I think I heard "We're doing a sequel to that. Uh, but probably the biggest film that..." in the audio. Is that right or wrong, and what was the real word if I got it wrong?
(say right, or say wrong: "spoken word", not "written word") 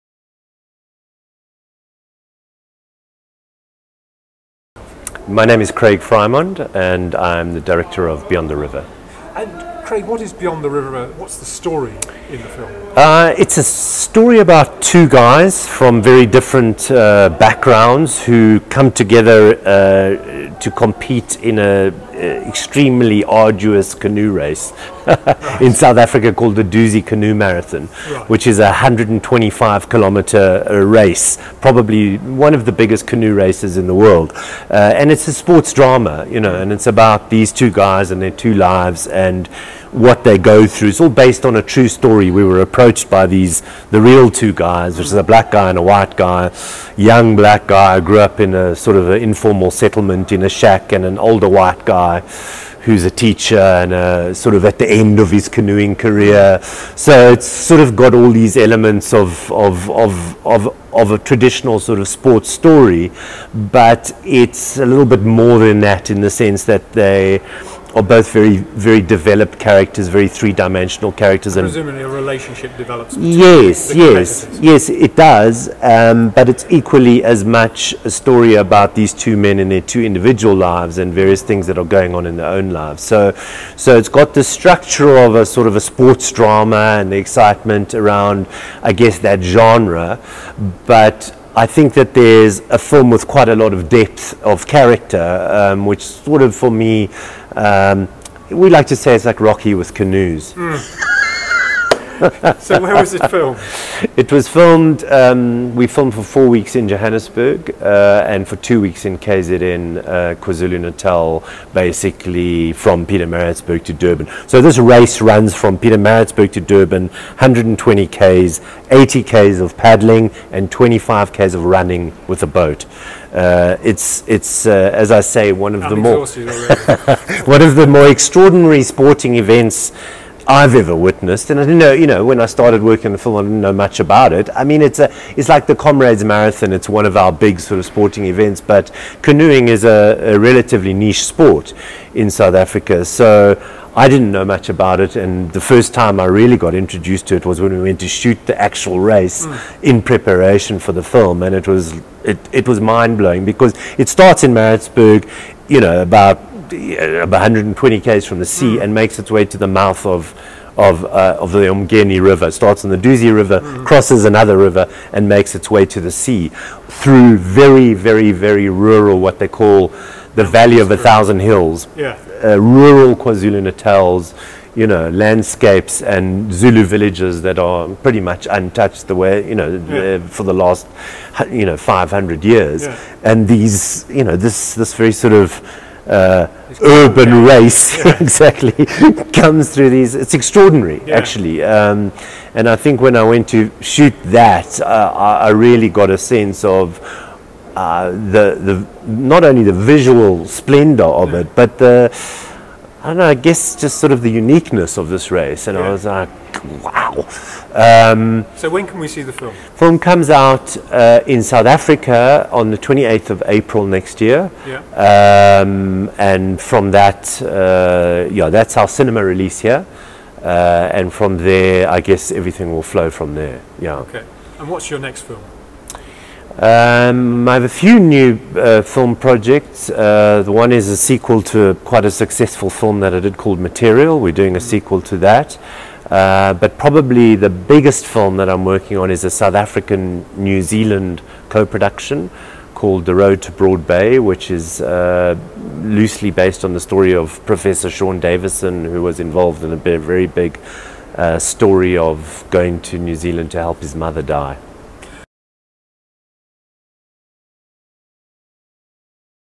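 right.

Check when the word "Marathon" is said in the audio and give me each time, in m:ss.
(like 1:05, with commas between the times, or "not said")
0:27, 2:16.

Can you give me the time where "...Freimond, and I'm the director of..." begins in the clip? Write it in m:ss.
0:05.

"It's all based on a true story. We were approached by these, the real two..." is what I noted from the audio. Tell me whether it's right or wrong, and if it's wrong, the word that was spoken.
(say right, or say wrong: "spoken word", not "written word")
right.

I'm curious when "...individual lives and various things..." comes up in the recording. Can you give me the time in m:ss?
1:20.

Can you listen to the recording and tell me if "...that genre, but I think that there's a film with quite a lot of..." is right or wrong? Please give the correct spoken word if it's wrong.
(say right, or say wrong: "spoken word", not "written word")
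right.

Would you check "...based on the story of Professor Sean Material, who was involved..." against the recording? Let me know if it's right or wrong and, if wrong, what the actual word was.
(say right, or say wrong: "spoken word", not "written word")
wrong: "Davison", not "Material".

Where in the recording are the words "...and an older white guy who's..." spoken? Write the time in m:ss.
0:50.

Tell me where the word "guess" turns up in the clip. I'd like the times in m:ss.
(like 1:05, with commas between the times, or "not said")
1:28, 3:23, 3:42.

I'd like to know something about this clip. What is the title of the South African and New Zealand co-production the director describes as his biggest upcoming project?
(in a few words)
The Road to Broad Bay.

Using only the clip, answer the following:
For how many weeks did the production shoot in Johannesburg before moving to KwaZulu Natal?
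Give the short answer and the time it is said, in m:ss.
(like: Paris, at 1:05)
4, at 1:46.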